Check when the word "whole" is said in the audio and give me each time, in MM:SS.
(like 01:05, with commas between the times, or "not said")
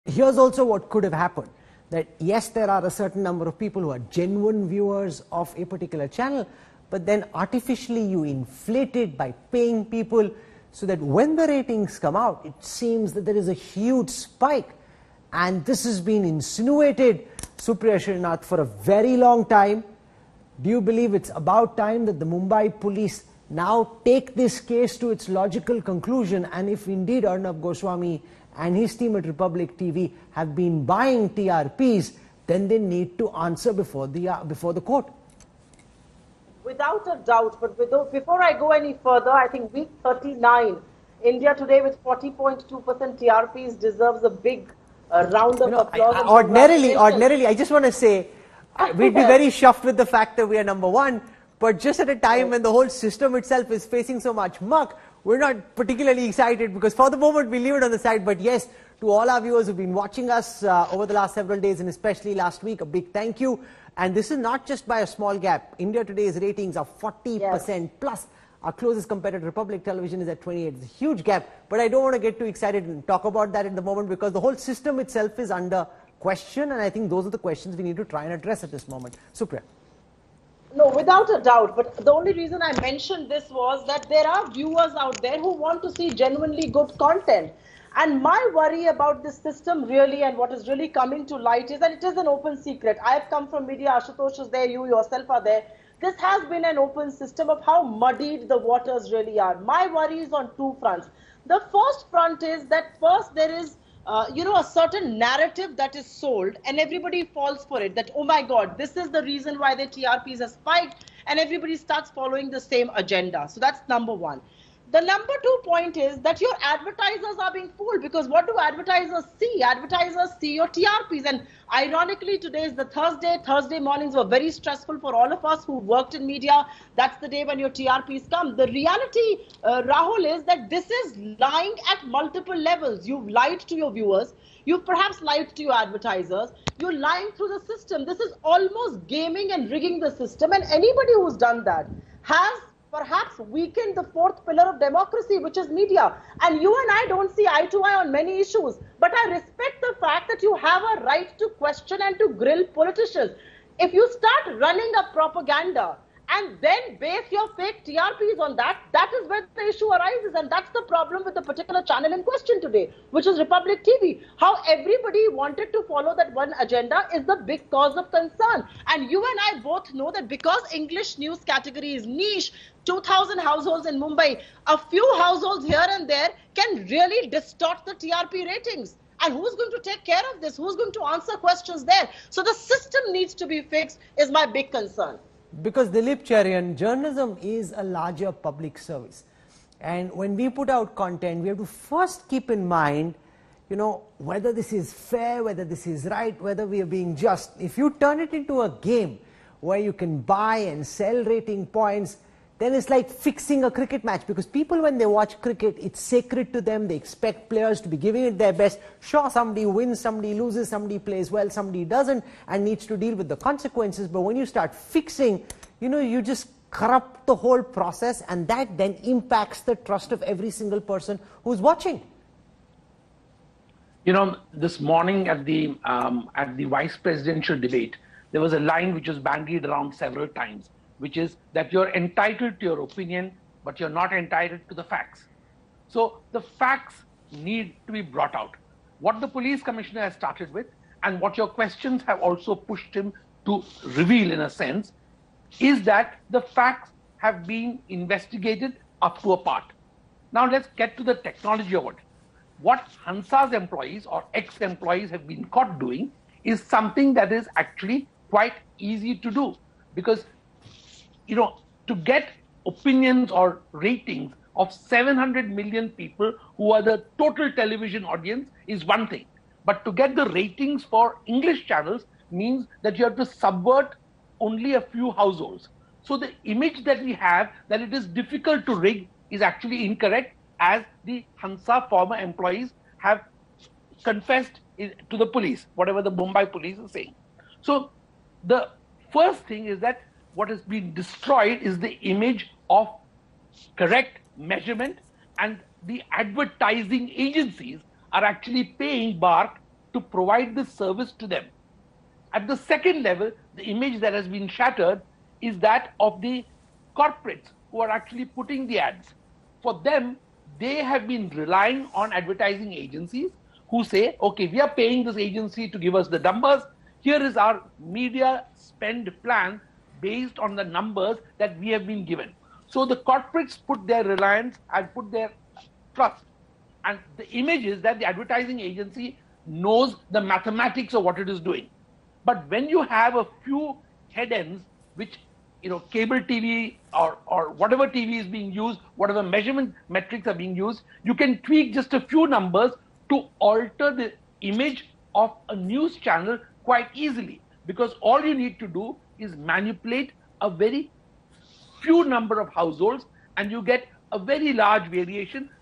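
00:52, 01:14, 03:37.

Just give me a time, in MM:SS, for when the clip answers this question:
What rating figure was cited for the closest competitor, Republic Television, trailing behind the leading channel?
01:10.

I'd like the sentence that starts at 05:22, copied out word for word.
So the corporates put their reliance and put their trust.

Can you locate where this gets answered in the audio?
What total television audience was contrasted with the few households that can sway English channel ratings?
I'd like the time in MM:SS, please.
04:24.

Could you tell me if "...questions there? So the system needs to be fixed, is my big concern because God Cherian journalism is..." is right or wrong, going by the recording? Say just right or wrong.
wrong.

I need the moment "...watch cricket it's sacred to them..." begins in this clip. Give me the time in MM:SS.
03:25.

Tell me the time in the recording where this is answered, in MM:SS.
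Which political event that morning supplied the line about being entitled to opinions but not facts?
03:46.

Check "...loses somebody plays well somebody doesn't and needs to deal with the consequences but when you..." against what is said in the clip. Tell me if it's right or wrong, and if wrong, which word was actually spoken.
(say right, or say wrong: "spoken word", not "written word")
right.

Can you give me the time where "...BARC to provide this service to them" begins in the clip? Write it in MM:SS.
04:59.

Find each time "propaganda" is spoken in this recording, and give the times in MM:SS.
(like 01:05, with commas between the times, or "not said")
02:35.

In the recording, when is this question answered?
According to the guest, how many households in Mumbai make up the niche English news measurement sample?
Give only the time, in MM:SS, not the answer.
02:52.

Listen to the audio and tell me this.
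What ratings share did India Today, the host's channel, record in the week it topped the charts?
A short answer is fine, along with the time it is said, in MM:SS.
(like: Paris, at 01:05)
40.2%, at 00:42.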